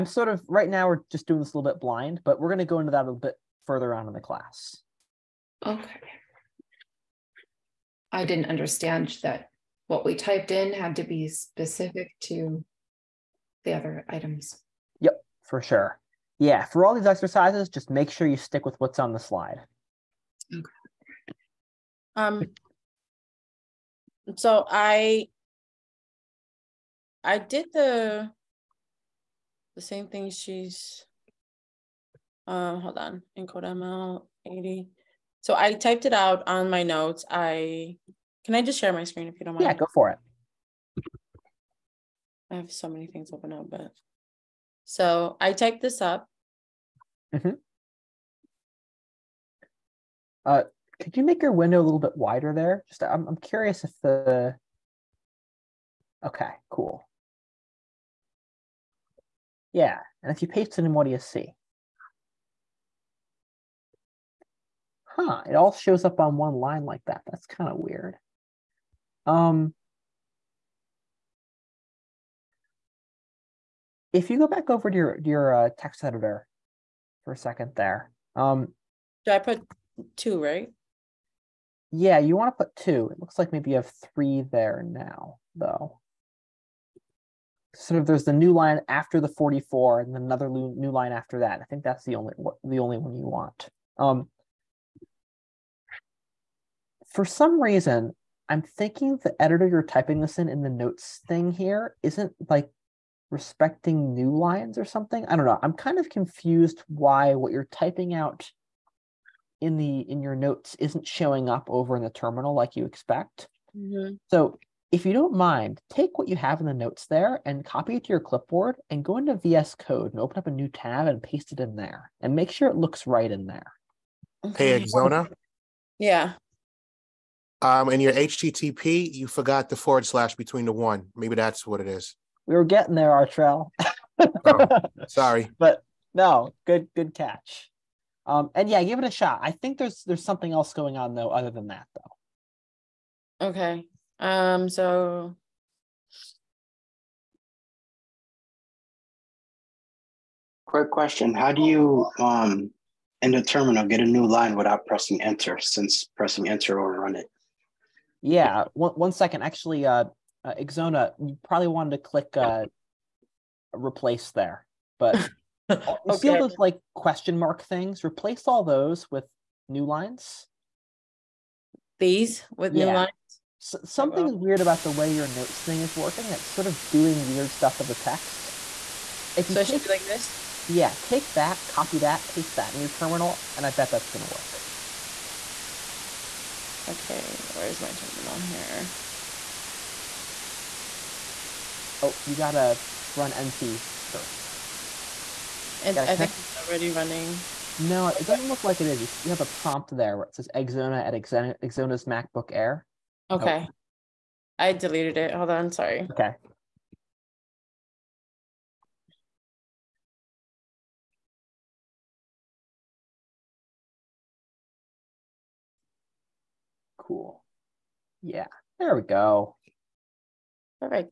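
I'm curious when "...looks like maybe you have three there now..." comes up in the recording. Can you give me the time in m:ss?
1:23.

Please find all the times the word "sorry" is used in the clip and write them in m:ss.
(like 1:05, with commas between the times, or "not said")
2:15, 3:25.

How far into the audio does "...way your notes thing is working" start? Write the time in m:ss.
2:54.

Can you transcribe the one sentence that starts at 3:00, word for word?
Yeah, take that, copy that, paste that in your terminal, and I bet that's going to work.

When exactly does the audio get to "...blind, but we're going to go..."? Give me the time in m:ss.
0:01.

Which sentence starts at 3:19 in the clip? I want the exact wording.
You have a prompt there where it says Exona at Exona's MacBook Air.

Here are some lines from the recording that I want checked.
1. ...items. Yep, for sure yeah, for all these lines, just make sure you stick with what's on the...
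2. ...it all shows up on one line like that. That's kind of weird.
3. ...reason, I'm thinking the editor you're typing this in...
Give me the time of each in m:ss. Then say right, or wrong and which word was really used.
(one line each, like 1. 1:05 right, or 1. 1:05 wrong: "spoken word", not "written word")
1. 0:14 wrong: "exercises", not "lines"
2. 1:05 right
3. 1:37 right.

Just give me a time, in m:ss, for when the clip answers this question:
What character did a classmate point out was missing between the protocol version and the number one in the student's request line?
2:09.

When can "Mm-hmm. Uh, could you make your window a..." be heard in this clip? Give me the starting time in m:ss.
0:47.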